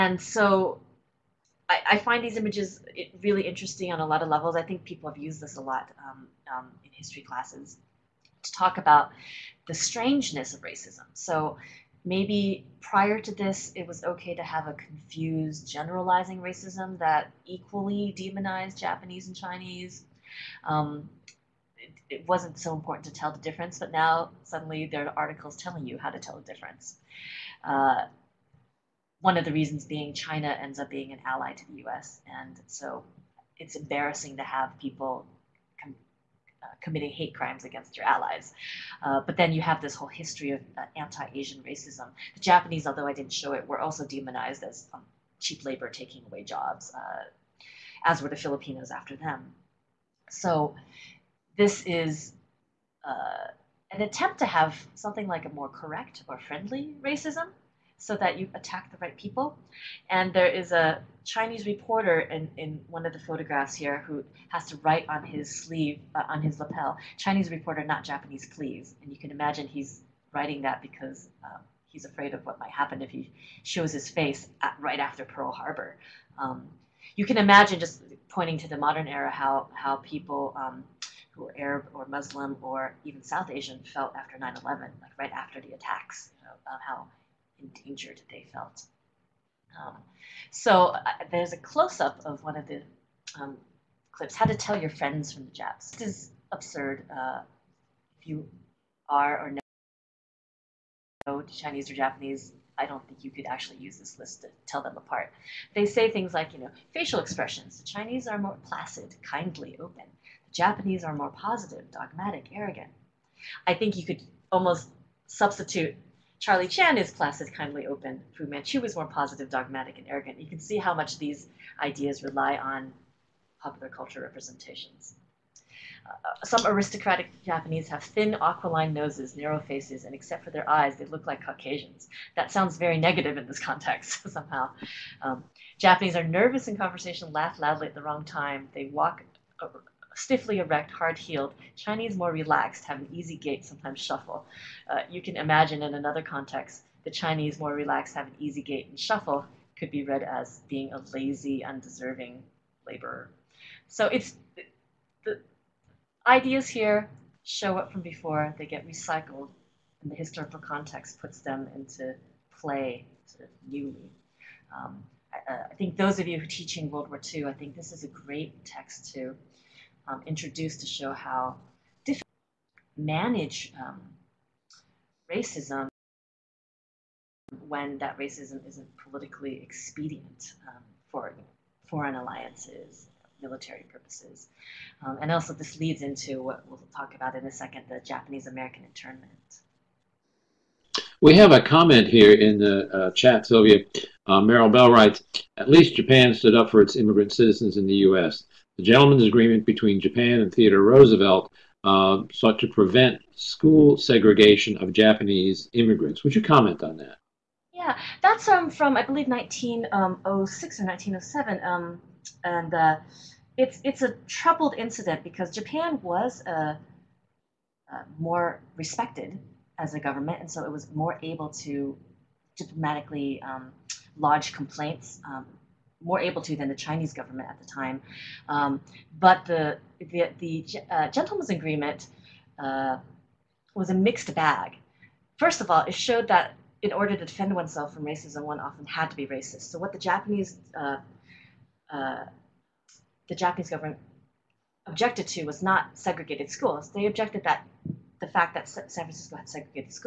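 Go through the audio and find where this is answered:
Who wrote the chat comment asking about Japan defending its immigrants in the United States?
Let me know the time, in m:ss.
3:14.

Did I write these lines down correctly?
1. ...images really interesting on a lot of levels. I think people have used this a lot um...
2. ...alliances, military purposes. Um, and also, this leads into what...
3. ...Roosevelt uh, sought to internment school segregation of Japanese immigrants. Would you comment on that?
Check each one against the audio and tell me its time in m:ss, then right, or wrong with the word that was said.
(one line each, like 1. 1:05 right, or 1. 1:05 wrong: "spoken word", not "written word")
1. 0:02 right
2. 3:02 right
3. 3:20 wrong: "prevent", not "internment".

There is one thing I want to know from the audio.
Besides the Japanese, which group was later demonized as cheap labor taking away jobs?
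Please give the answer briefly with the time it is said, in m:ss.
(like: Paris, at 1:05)
Filipinos, at 0:48.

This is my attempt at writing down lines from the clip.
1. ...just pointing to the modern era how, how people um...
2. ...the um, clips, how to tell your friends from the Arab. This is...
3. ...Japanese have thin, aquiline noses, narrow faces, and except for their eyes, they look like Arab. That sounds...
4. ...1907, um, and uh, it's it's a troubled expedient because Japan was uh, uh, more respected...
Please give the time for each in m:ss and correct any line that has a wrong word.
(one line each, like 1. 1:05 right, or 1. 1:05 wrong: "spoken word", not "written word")
1. 1:17 right
2. 1:32 wrong: "Japs", not "Arab"
3. 2:07 wrong: "Caucasians", not "Arab"
4. 3:30 wrong: "incident", not "expedient".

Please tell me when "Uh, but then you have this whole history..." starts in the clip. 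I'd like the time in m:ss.
0:39.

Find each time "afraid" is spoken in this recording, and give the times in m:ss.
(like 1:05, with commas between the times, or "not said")
1:12.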